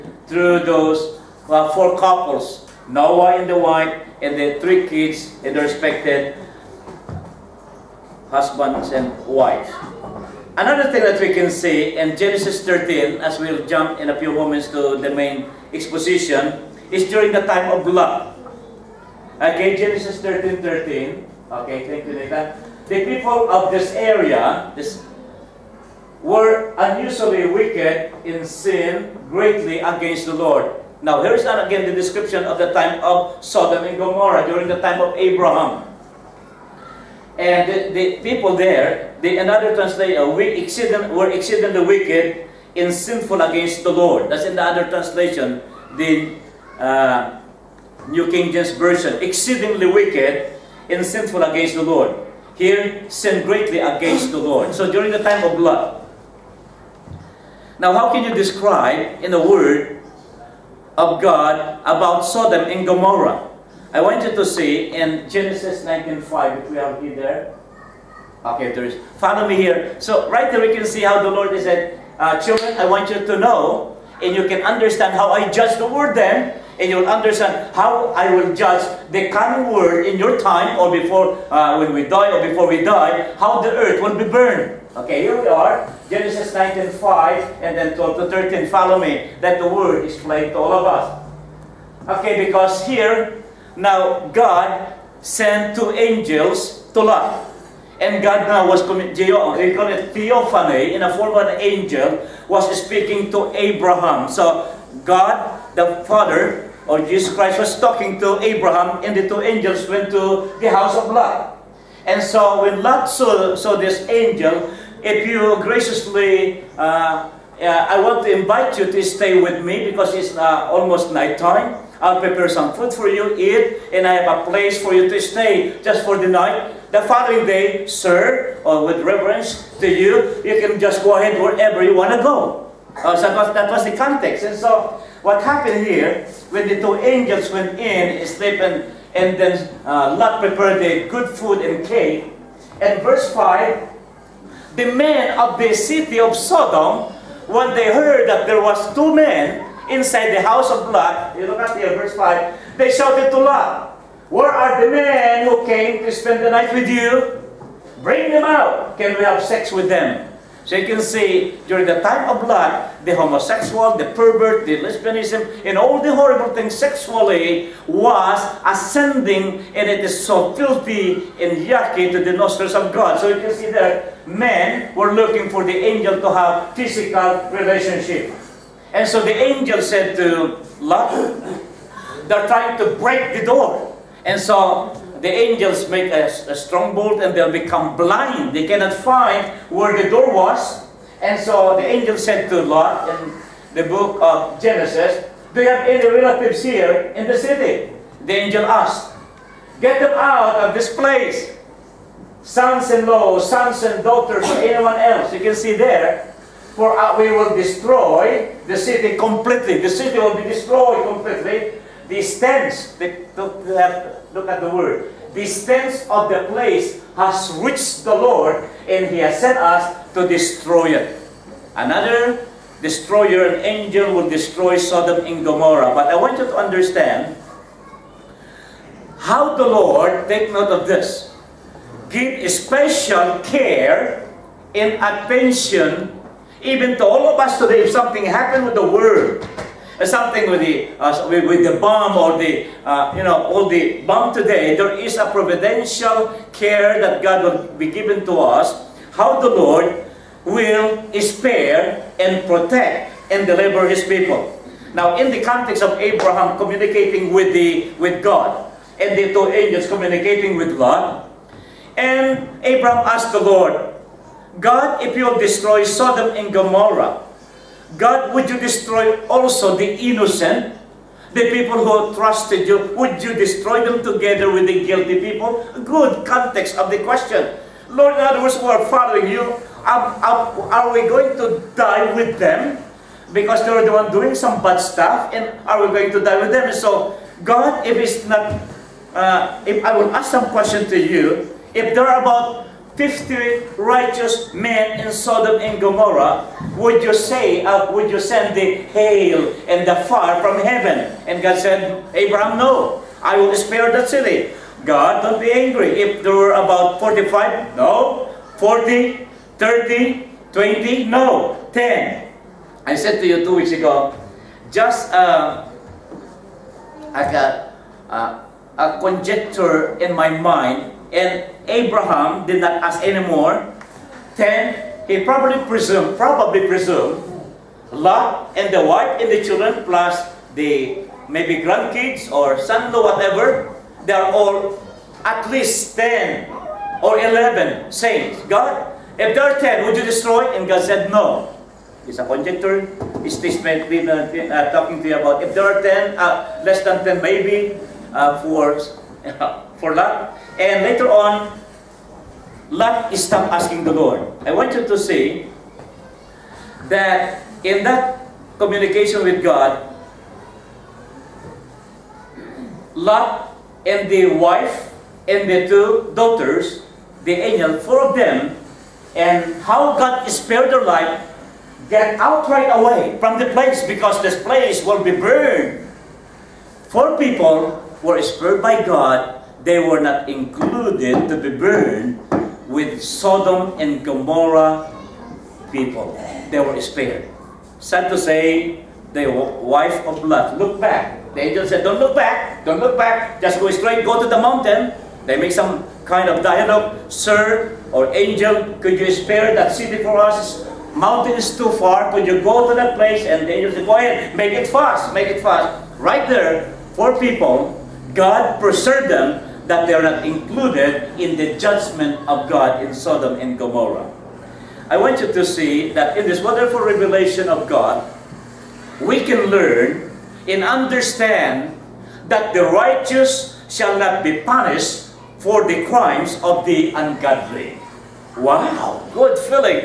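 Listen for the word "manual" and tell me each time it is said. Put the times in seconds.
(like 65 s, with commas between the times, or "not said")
not said.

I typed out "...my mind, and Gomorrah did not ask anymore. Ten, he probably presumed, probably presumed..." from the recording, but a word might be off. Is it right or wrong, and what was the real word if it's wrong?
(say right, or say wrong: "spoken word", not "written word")
wrong: "Abraham", not "Gomorrah".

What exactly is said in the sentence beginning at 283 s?
Because they're the one doing some bad stuff, and are we going to die with them?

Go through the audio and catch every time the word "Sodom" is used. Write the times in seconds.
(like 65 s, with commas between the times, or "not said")
33 s, 62 s, 146 s, 224 s, 265 s, 295 s, 383 s, 412 s.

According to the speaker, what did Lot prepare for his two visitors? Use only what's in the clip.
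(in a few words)
cake.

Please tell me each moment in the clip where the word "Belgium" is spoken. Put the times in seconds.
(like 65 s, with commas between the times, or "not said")
not said.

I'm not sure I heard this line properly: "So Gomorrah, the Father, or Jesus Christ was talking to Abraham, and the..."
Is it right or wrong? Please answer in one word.
wrong.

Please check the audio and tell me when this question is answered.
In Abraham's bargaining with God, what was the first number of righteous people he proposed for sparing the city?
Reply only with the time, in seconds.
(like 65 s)
292 s.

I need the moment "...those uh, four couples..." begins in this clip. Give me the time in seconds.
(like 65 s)
0 s.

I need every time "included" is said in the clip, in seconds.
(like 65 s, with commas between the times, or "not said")
380 s, 410 s.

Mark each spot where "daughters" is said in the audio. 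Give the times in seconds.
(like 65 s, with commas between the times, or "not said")
204 s, 366 s.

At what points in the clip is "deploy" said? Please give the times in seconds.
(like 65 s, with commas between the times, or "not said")
not said.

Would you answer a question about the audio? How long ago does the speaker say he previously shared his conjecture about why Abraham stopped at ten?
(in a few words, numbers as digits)
Two weeks ago.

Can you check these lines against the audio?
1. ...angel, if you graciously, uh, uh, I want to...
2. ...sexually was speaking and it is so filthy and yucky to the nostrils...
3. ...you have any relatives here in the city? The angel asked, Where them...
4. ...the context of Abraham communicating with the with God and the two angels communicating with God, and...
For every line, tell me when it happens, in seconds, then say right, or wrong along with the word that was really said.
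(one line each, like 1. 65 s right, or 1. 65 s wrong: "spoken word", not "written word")
1. 114 s right
2. 166 s wrong: "ascending", not "speaking"
3. 195 s wrong: "Get", not "Where"
4. 255 s right.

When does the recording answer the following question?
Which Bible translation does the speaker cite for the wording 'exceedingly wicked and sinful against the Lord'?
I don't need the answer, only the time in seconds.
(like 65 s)
48 s.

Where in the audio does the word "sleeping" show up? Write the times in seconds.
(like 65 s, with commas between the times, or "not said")
138 s.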